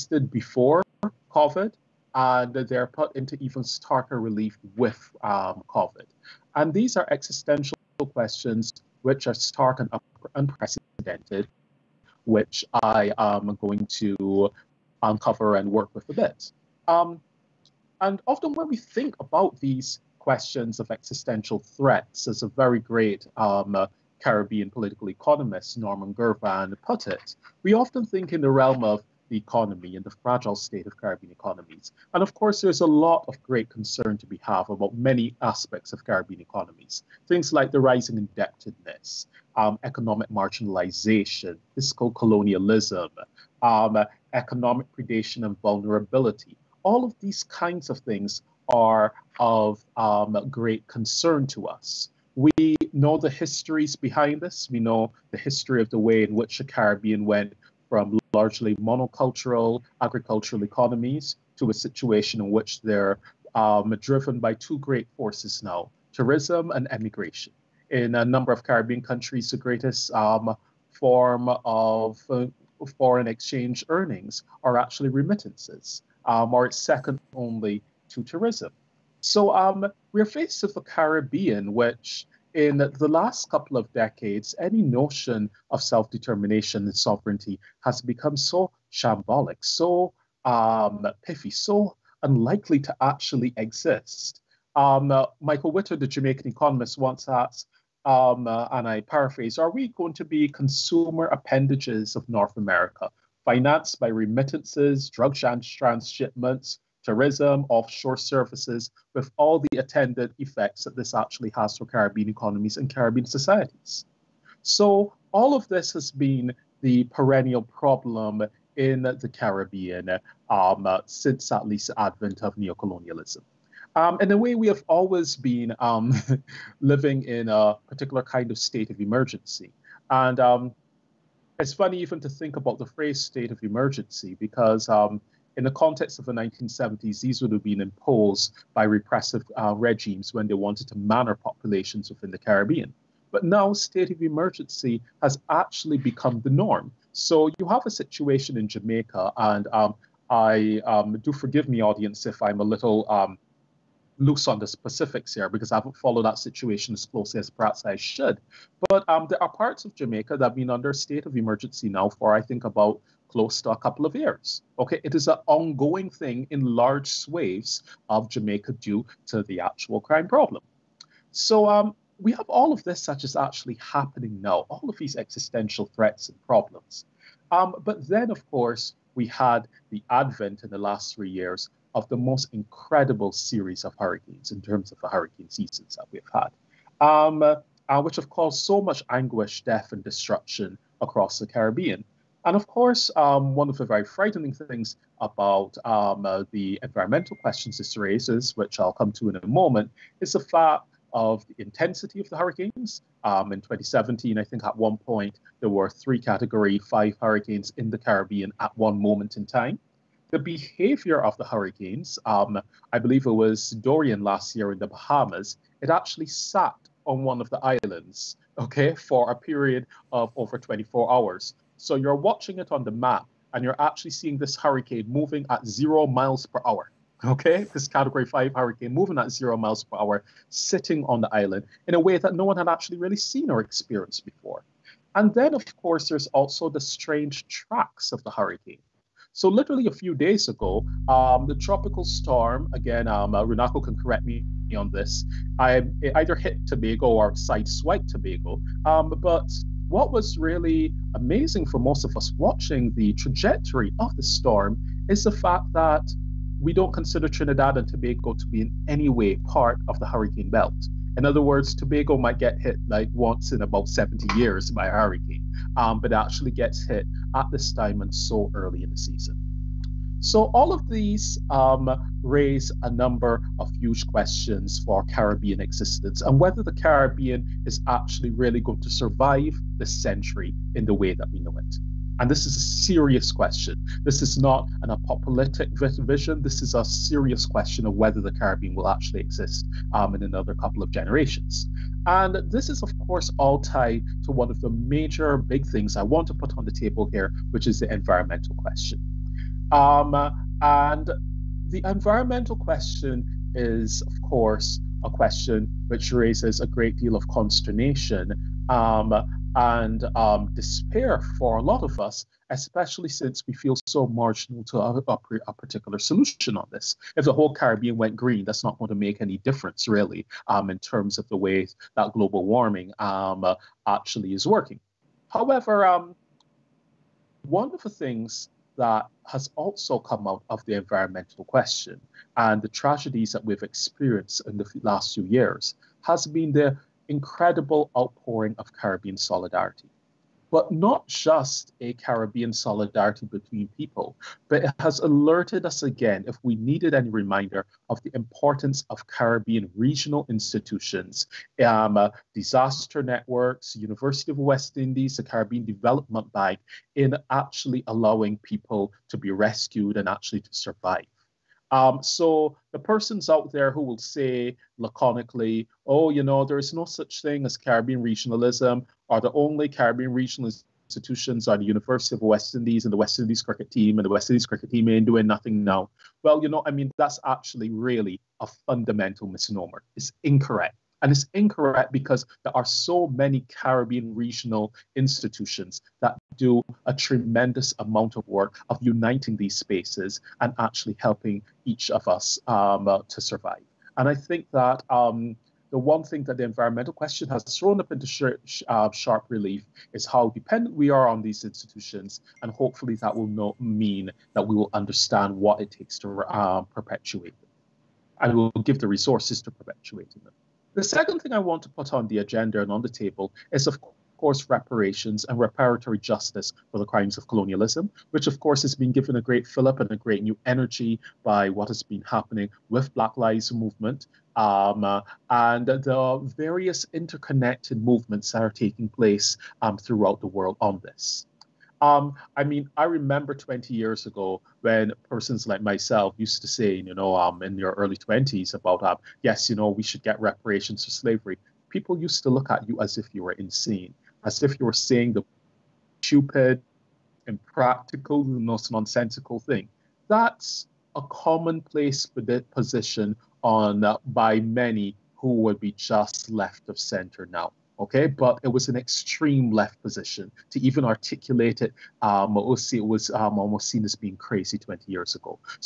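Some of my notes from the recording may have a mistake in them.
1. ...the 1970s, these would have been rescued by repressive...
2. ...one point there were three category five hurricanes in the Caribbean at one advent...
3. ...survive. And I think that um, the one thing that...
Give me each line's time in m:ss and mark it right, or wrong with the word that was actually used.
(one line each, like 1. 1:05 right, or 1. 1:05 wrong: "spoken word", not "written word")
1. 2:16 wrong: "imposed", not "rescued"
2. 3:24 wrong: "moment", not "advent"
3. 6:33 right.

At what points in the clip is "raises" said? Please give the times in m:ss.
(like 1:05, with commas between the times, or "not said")
3:17, 4:32, 5:06.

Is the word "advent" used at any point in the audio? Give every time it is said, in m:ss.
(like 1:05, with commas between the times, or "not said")
2:01, 3:00.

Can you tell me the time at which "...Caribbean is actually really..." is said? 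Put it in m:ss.
4:36.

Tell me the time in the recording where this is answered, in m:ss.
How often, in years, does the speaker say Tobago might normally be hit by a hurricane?
4:23.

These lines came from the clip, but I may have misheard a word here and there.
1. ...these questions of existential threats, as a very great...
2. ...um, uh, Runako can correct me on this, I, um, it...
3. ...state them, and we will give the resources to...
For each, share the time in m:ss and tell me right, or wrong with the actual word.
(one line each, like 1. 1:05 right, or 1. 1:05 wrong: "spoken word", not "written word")
1. 0:19 right
2. 4:03 right
3. 6:46 wrong: "perpetuate", not "state".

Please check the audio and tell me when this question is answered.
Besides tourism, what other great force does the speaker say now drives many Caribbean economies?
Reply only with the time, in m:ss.
1:06.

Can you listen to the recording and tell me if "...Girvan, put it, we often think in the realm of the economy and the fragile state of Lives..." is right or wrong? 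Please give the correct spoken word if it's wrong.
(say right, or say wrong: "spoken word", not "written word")
wrong: "Caribbean", not "Lives".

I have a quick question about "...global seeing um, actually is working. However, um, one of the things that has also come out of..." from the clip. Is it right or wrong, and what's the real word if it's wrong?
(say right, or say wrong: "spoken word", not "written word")
wrong: "warming", not "seeing".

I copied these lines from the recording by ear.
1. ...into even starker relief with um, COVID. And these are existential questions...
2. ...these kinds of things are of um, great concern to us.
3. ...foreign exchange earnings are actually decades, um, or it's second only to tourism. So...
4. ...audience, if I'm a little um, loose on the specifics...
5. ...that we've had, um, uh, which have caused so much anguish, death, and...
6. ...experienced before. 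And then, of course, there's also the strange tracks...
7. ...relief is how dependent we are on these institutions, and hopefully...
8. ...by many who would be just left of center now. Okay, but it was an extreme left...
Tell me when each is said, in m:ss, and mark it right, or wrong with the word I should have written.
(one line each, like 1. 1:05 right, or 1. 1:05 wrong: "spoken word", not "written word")
1. 0:03 right
2. 0:47 right
3. 1:12 wrong: "remittances", not "decades"
4. 2:31 right
5. 3:05 right
6. 3:53 right
7. 6:39 right
8. 7:34 right.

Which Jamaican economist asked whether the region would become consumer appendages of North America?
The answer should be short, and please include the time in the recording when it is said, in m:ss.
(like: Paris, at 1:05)
Michael Witter, at 1:35.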